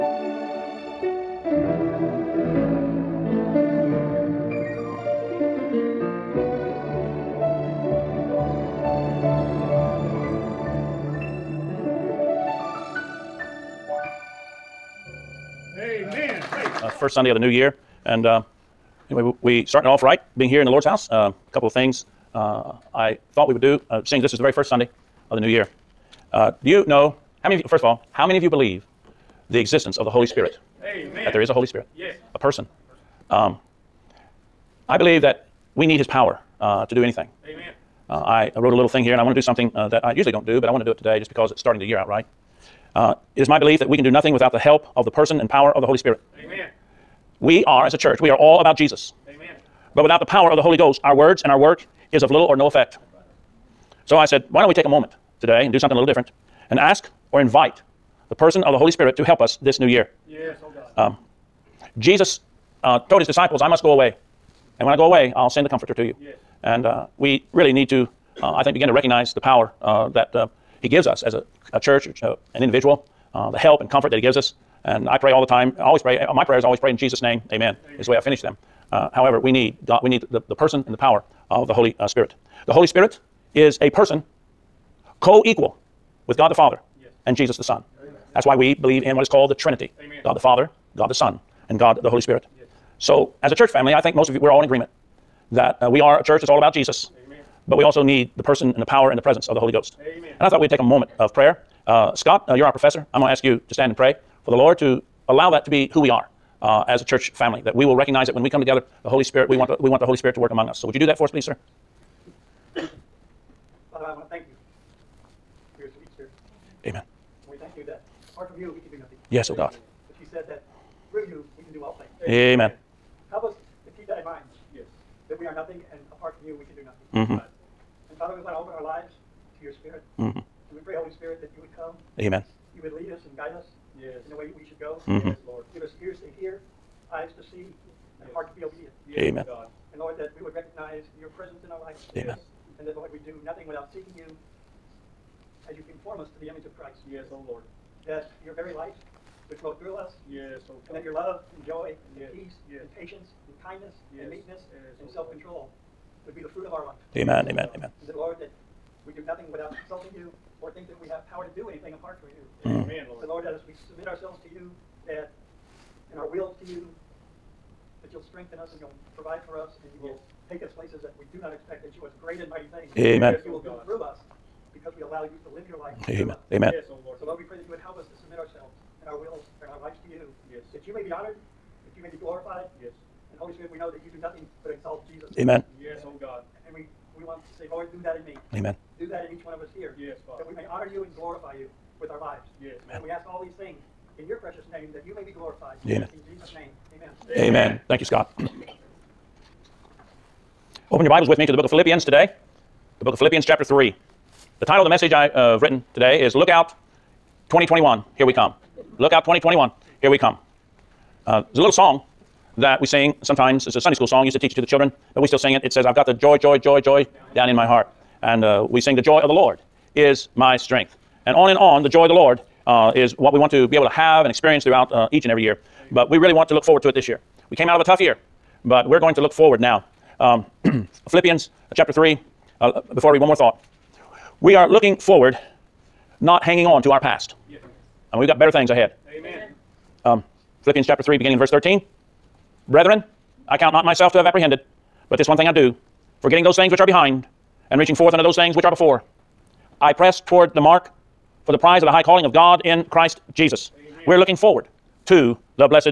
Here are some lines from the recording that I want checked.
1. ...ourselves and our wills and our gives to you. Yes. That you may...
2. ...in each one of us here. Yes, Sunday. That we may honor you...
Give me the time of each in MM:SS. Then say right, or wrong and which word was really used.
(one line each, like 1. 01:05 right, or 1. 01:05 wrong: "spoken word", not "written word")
1. 02:58 wrong: "lives", not "gives"
2. 03:09 wrong: "Father", not "Sunday".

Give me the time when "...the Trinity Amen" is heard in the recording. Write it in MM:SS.
01:29.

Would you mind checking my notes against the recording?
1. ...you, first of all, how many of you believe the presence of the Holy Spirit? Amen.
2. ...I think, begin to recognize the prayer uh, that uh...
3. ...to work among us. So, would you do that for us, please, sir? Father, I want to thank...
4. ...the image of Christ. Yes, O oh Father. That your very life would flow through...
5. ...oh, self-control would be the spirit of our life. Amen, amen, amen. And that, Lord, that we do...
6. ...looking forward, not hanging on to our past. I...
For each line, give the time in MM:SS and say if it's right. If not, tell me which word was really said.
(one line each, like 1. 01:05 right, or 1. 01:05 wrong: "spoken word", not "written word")
1. 00:27 wrong: "existence", not "presence"
2. 01:08 wrong: "power", not "prayer"
3. 01:50 right
4. 02:26 wrong: "Lord", not "Father"
5. 02:35 wrong: "fruit", not "spirit"
6. 03:54 right.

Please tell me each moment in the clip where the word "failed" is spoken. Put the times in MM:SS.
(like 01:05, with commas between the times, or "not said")
not said.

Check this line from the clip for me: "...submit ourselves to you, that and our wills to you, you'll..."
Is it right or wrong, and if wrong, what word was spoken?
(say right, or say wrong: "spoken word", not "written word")
right.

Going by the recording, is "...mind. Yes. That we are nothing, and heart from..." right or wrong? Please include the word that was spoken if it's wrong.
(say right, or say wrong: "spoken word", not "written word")
wrong: "apart", not "heart".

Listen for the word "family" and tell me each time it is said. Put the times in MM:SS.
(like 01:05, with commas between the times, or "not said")
01:33, 01:47.